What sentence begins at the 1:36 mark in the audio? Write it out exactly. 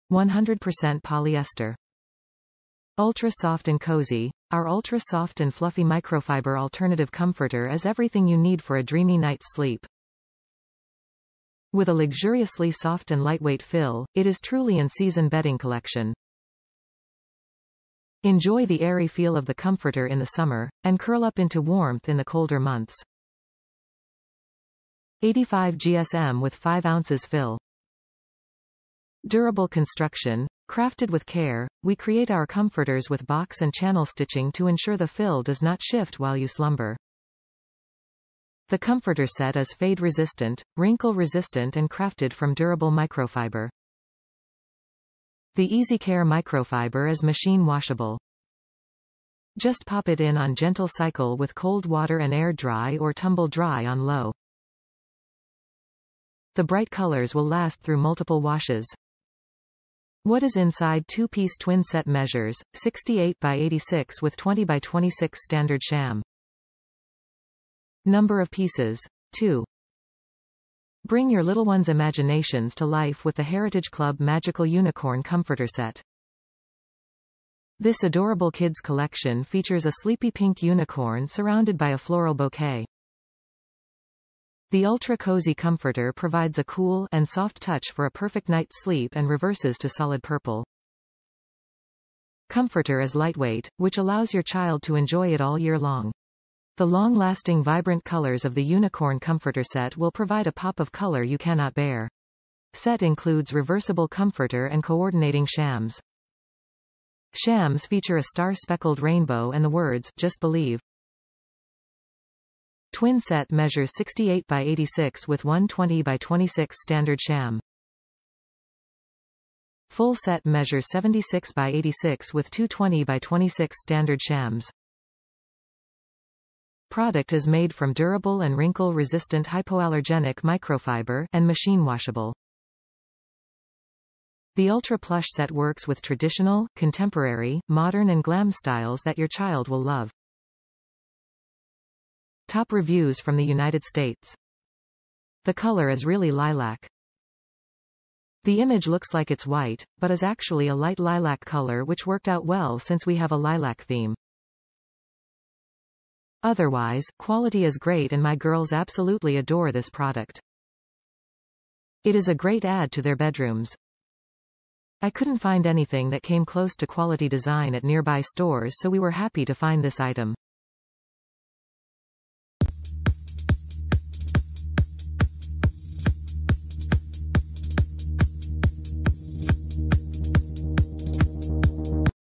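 The long-lasting vibrant colors of the Unicorn Comforter set will provide a pop of color you cannot bear.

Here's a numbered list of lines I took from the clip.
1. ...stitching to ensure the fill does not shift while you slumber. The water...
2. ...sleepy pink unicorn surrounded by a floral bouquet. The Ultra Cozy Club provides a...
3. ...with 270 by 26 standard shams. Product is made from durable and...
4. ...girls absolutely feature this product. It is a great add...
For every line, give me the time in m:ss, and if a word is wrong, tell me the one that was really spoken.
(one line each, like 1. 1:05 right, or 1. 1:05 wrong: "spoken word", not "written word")
1. 0:34 wrong: "comforter", not "water"
2. 1:20 wrong: "Comforter", not "Club"
3. 2:02 wrong: "220", not "270"
4. 2:38 wrong: "adore", not "feature".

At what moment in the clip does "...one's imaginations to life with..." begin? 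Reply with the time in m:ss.
1:11.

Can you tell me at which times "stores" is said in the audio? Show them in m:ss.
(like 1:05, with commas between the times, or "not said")
2:48.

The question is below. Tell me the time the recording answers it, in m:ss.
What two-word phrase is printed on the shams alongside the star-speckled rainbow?
1:50.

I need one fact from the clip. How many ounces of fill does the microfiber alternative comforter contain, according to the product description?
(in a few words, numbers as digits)
5.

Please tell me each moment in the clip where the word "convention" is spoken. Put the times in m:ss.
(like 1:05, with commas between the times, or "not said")
not said.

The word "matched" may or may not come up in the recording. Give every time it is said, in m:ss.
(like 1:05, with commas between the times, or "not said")
not said.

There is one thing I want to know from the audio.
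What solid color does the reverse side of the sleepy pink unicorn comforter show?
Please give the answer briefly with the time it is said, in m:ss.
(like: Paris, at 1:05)
purple, at 1:29.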